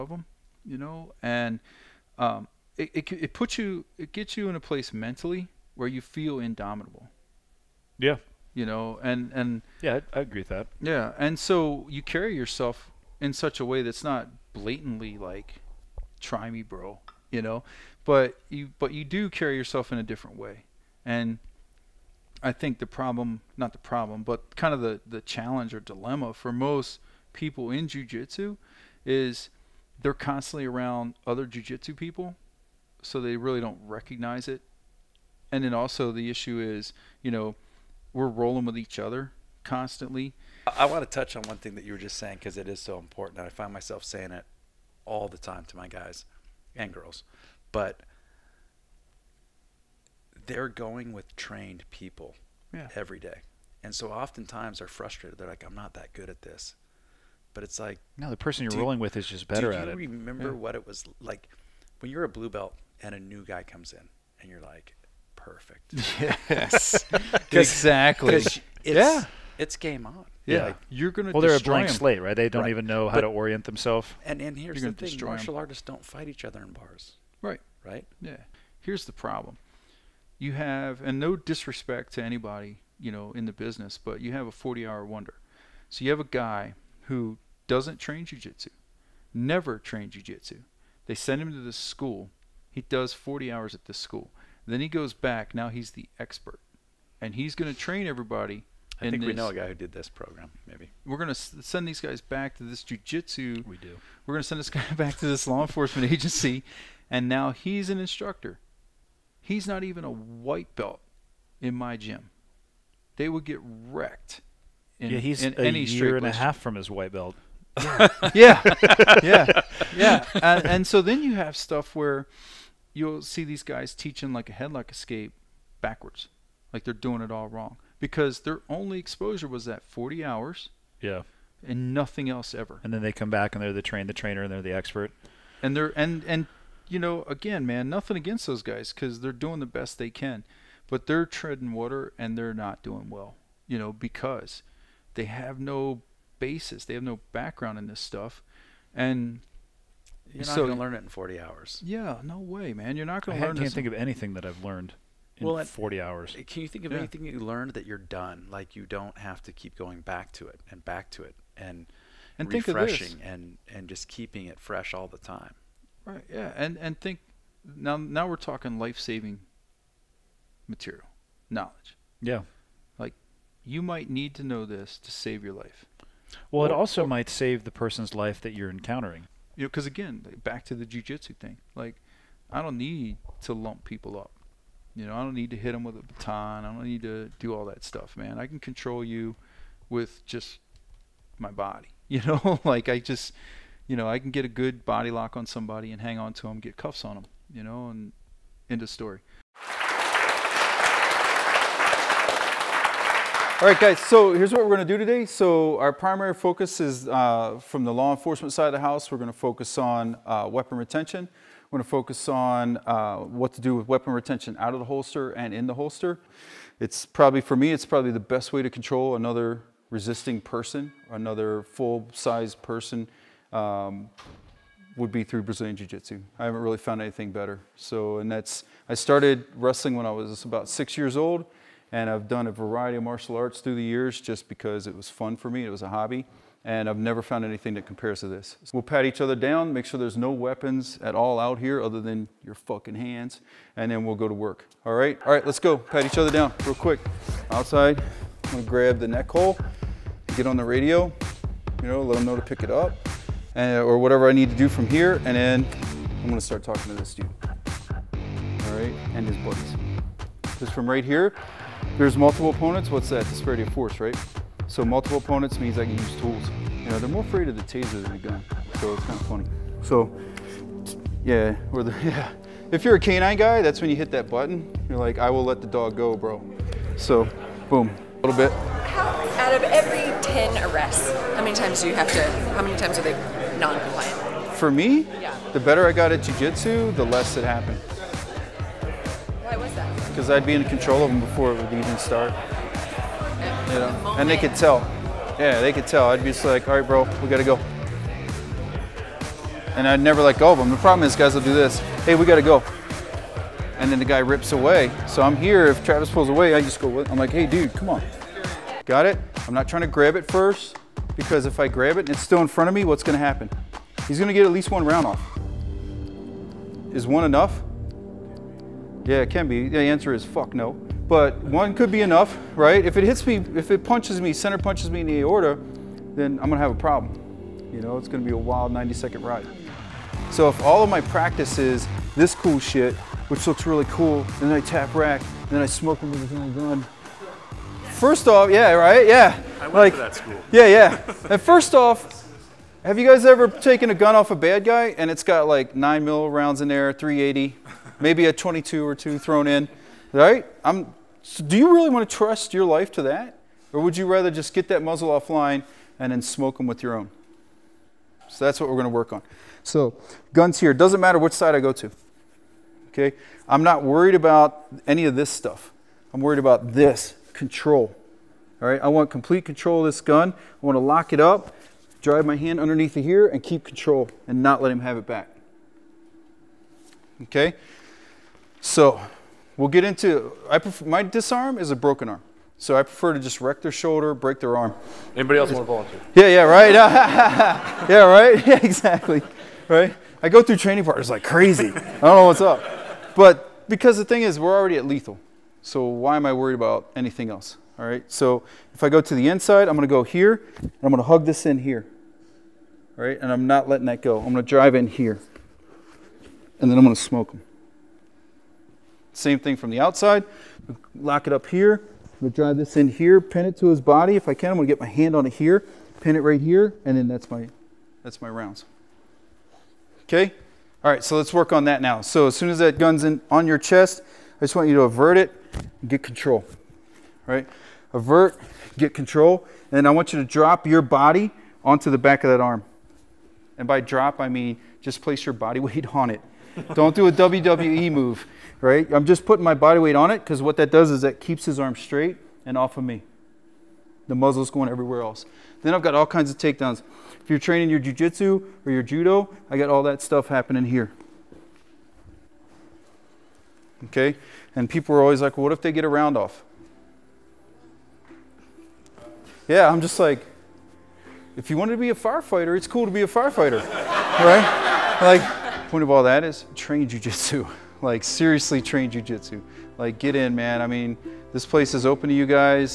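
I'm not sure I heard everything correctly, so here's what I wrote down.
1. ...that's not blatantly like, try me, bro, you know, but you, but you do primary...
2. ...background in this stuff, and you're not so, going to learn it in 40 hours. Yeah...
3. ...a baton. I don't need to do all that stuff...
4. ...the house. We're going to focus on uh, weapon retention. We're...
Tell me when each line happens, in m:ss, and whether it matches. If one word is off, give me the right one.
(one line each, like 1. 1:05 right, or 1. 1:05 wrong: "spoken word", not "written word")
1. 0:13 wrong: "carry", not "primary"
2. 2:27 right
3. 3:05 right
4. 3:28 right.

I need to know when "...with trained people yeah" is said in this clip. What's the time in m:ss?
0:51.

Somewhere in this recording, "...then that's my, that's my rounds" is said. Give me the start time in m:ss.
6:56.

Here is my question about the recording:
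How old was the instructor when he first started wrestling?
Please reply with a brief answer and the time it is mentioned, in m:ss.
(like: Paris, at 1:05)
6, at 3:50.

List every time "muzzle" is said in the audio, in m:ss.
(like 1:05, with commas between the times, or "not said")
5:54, 7:24.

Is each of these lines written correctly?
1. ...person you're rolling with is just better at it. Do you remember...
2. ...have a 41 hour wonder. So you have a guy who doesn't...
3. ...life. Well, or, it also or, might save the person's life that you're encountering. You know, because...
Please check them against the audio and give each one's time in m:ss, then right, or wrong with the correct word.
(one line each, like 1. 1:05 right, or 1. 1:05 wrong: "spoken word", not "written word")
1. 0:58 right
2. 1:24 wrong: "40", not "41"
3. 2:55 right.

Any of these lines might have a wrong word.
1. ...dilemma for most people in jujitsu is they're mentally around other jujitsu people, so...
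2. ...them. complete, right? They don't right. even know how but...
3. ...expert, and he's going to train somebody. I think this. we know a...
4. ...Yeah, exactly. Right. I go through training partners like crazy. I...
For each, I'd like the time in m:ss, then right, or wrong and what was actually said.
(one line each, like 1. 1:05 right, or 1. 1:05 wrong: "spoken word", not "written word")
1. 0:25 wrong: "constantly", not "mentally"
2. 1:11 wrong: "slate", not "complete"
3. 1:36 wrong: "everybody", not "somebody"
4. 6:28 right.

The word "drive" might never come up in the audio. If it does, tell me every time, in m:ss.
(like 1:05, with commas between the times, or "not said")
6:12, 6:44, 6:52.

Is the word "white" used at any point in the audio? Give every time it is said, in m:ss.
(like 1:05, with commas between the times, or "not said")
1:50, 1:56.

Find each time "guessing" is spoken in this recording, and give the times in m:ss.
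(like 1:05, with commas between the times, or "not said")
not said.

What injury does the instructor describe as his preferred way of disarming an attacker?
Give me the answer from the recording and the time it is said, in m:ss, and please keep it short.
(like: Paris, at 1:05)
broken arm, at 6:21.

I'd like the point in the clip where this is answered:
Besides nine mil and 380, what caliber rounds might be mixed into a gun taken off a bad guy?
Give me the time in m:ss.
5:48.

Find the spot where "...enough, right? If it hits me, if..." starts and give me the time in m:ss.
5:22.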